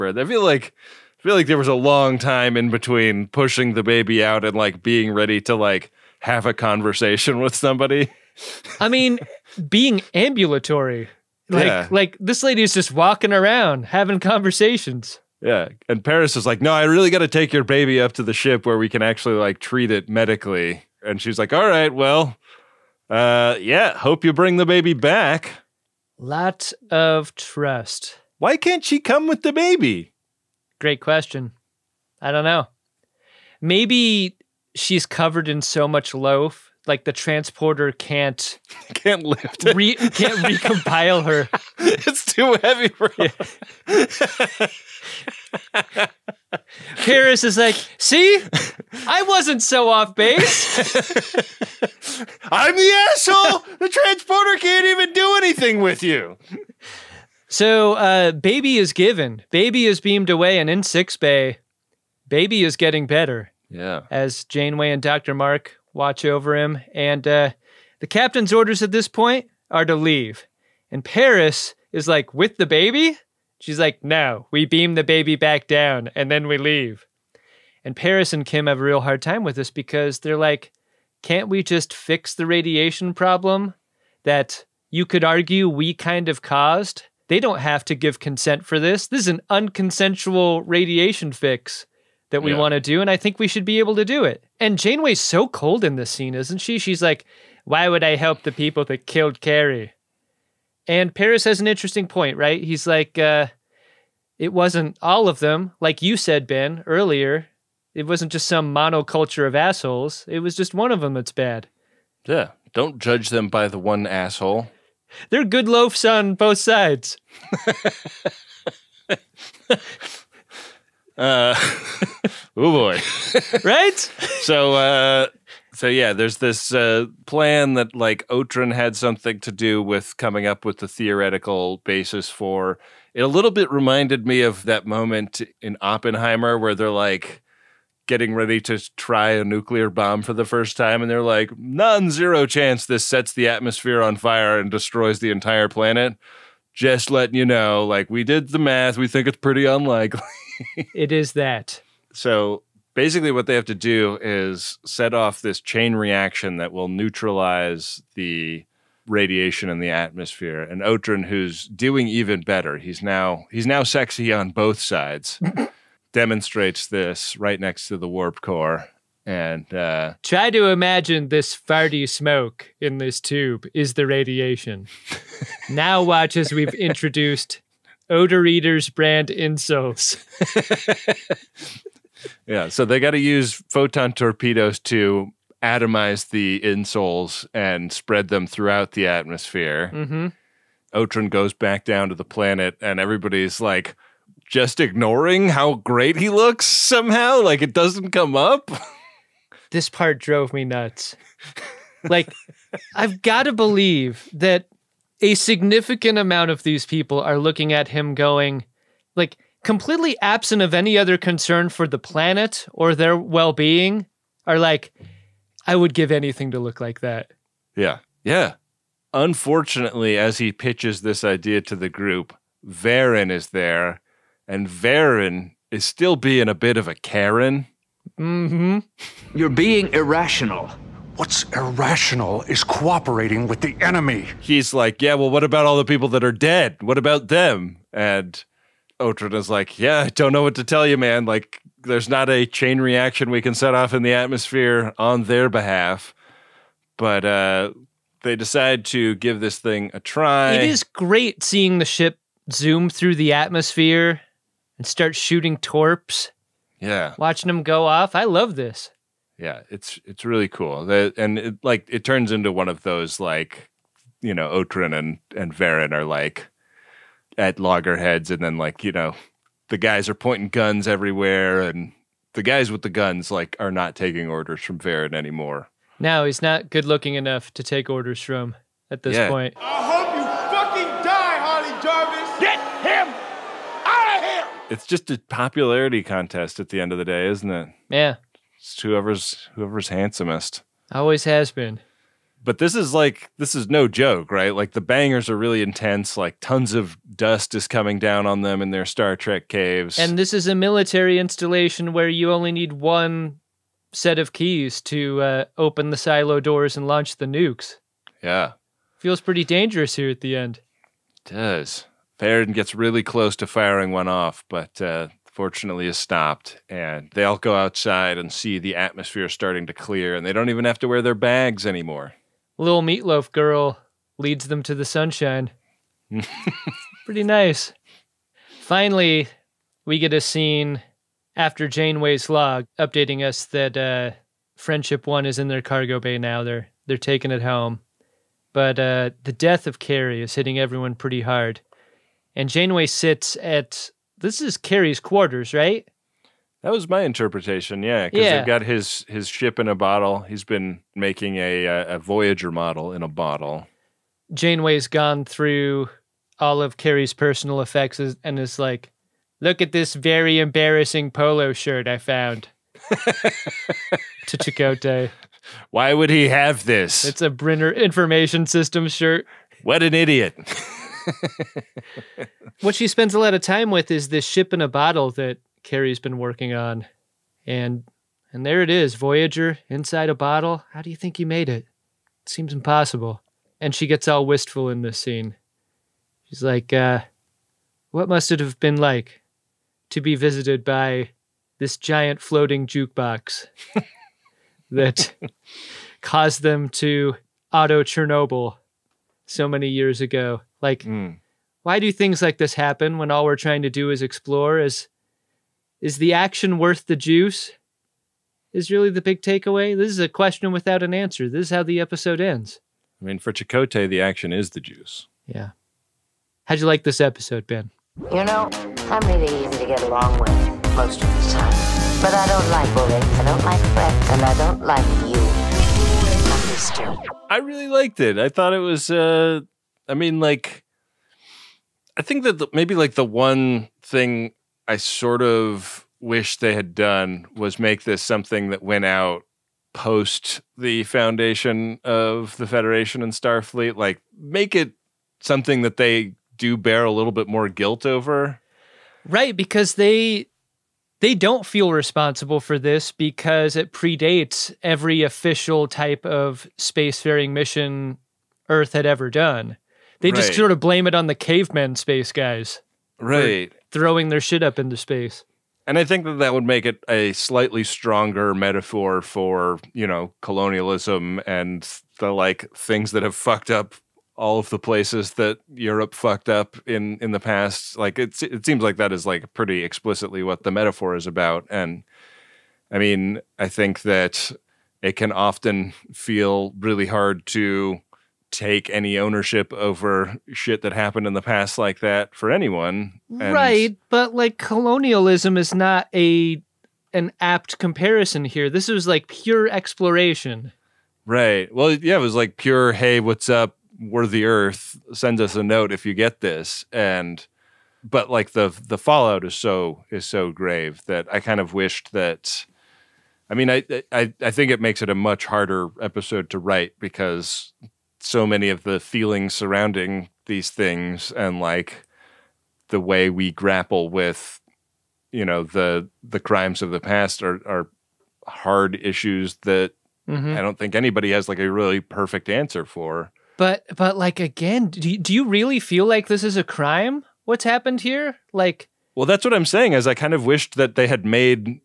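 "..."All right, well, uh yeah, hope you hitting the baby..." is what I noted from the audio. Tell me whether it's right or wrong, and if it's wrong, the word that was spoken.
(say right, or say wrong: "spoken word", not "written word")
wrong: "bring", not "hitting".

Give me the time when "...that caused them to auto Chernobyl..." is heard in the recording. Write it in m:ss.
6:34.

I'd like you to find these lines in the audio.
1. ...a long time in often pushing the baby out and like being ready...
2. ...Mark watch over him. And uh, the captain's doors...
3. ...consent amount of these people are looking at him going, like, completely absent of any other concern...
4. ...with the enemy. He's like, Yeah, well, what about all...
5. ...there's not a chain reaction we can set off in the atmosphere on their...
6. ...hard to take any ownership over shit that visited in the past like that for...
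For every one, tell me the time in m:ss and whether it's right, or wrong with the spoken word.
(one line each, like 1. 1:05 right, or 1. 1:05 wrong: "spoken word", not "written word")
1. 0:01 wrong: "between", not "often"
2. 1:05 wrong: "orders", not "doors"
3. 3:25 wrong: "significant", not "consent"
4. 3:53 right
5. 4:01 right
6. 8:06 wrong: "happened", not "visited".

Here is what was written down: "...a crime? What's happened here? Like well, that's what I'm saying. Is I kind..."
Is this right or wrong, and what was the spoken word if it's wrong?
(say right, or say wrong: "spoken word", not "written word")
right.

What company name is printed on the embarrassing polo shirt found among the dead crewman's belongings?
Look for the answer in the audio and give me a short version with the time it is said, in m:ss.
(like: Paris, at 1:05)
Brenner Information System, at 6:07.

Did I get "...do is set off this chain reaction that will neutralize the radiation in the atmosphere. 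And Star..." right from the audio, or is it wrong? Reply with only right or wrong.
wrong.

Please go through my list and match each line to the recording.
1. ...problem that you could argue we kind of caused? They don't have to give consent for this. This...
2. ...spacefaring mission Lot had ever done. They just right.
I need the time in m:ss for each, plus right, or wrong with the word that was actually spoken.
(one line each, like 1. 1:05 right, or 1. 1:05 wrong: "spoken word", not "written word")
1. 1:23 right
2. 7:36 wrong: "Earth", not "Lot".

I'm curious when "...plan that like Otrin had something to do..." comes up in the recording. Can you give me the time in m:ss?
2:07.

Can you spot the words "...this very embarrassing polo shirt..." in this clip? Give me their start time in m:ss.
5:59.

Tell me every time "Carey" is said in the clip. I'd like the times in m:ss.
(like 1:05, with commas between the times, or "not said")
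1:39, 5:39, 5:44, 5:56, 6:15.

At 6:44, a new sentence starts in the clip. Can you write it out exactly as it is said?
Is is the action worth the juice?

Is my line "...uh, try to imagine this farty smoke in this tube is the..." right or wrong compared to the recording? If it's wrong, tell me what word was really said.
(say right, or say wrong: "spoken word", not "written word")
right.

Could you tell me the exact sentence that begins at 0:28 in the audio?
Why can't she come with the baby?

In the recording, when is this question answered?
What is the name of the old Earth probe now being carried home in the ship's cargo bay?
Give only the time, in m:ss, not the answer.
5:34.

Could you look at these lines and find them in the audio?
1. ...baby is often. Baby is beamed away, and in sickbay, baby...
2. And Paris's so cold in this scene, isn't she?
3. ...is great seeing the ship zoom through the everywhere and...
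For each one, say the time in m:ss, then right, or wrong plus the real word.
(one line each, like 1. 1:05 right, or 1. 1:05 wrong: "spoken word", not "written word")
1. 0:58 wrong: "given", not "often"
2. 1:34 wrong: "Janeway", not "Paris"
3. 4:10 wrong: "atmosphere", not "everywhere".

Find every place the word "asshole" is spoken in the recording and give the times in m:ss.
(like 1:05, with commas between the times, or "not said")
0:53, 1:49, 1:54.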